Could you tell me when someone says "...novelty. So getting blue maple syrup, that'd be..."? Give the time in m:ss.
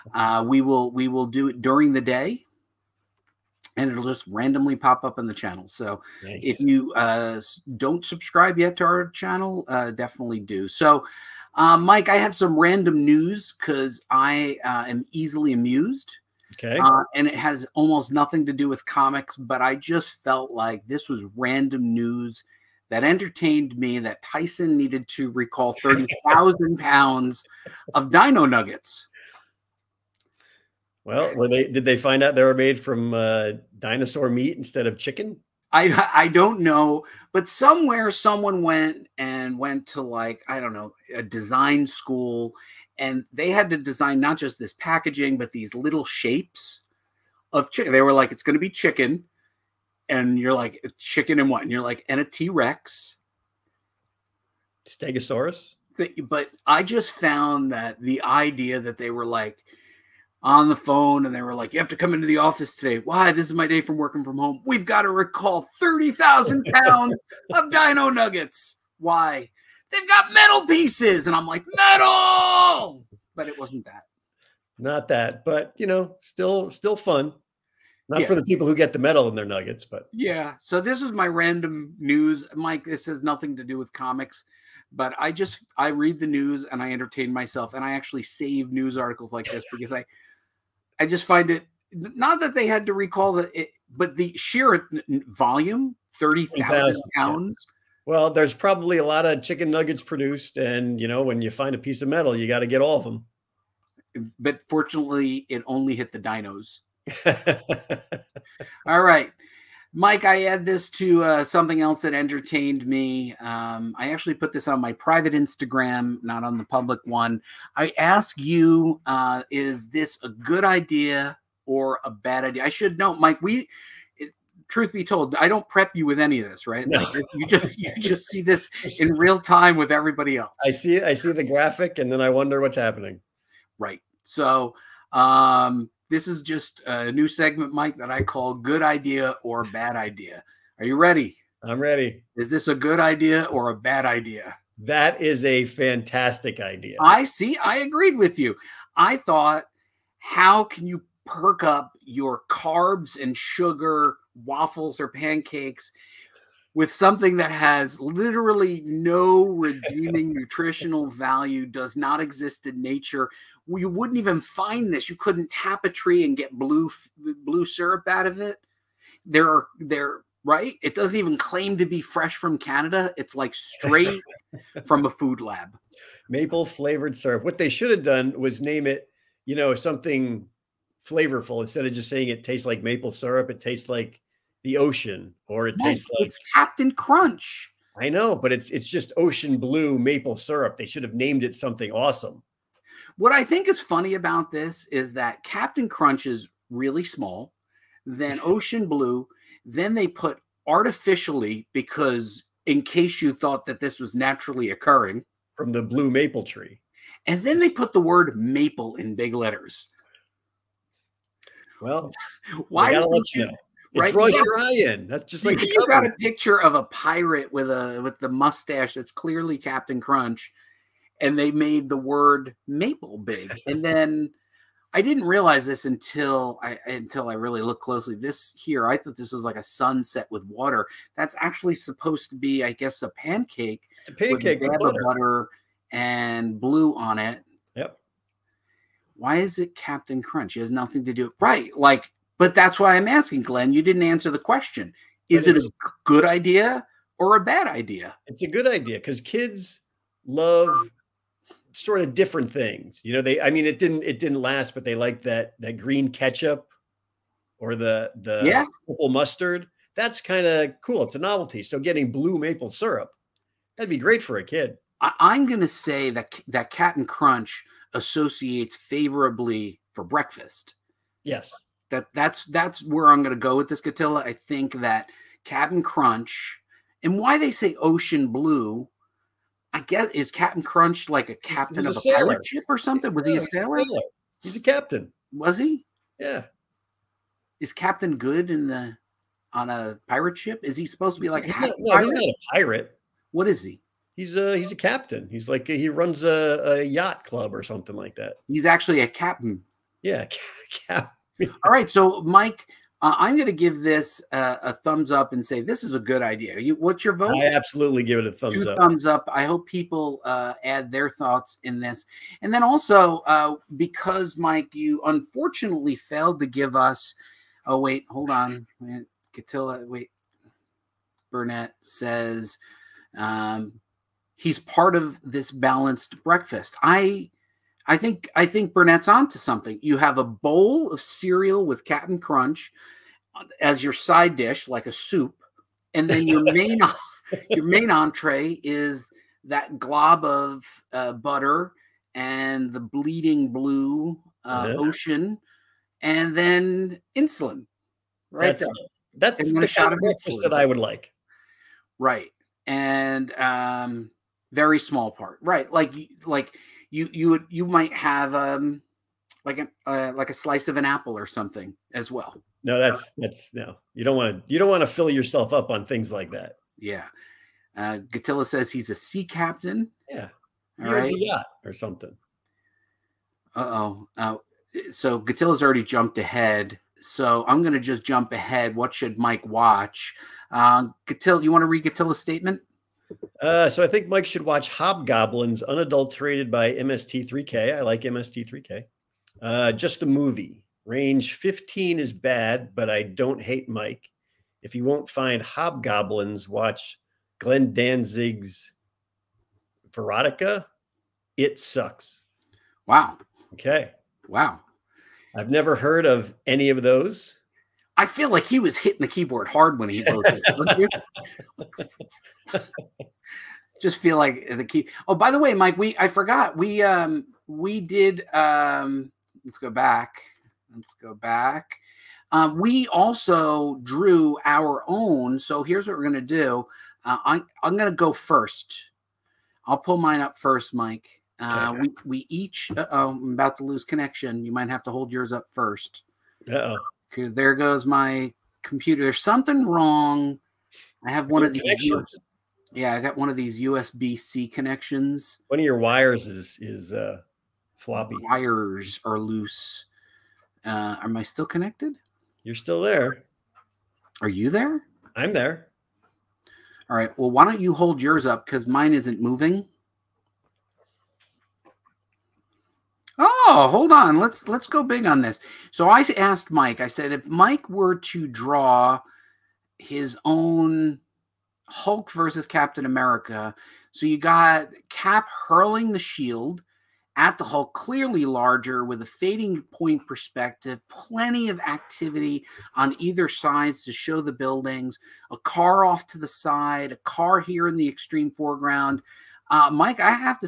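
4:21.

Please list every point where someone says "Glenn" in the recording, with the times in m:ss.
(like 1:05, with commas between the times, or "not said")
4:03, 6:37.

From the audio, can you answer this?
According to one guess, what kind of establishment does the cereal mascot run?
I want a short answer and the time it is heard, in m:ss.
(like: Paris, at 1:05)
a yacht club, at 4:56.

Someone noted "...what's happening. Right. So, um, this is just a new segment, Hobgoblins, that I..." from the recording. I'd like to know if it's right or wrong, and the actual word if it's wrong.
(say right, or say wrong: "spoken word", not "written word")
wrong: "Mike", not "Hobgoblins".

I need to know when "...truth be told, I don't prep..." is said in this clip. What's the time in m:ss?
2:04.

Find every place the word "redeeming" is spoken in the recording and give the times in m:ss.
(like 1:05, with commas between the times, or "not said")
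2:39.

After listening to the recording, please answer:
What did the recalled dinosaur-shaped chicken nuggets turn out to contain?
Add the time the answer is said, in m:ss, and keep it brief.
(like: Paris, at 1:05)
metal pieces, at 1:10.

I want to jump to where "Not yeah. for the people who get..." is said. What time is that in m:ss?
1:18.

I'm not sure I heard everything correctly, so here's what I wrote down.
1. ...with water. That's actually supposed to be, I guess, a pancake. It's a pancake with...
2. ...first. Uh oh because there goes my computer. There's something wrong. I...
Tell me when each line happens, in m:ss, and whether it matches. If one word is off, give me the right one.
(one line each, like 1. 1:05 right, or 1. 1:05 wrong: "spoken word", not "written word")
1. 3:50 right
2. 7:15 right.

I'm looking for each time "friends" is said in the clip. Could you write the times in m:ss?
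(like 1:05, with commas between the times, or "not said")
not said.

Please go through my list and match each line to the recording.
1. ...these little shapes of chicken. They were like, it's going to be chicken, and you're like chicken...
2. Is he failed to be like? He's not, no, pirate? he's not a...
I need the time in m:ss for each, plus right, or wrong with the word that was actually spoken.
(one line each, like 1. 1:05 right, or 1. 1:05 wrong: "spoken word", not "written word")
1. 0:45 right
2. 4:50 wrong: "supposed", not "failed".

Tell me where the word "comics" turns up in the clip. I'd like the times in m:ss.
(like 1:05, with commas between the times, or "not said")
0:18, 1:23.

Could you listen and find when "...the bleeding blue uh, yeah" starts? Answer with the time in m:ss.
5:42.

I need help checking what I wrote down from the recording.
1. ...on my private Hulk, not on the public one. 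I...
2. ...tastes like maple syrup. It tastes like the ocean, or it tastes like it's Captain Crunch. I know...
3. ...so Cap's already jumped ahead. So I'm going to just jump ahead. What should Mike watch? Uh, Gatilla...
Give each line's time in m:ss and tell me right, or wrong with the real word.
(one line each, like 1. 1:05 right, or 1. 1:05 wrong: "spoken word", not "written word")
1. 1:54 wrong: "Instagram", not "Hulk"
2. 3:02 right
3. 6:14 wrong: "Gatilla", not "Cap".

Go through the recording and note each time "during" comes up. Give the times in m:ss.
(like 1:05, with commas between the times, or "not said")
0:01.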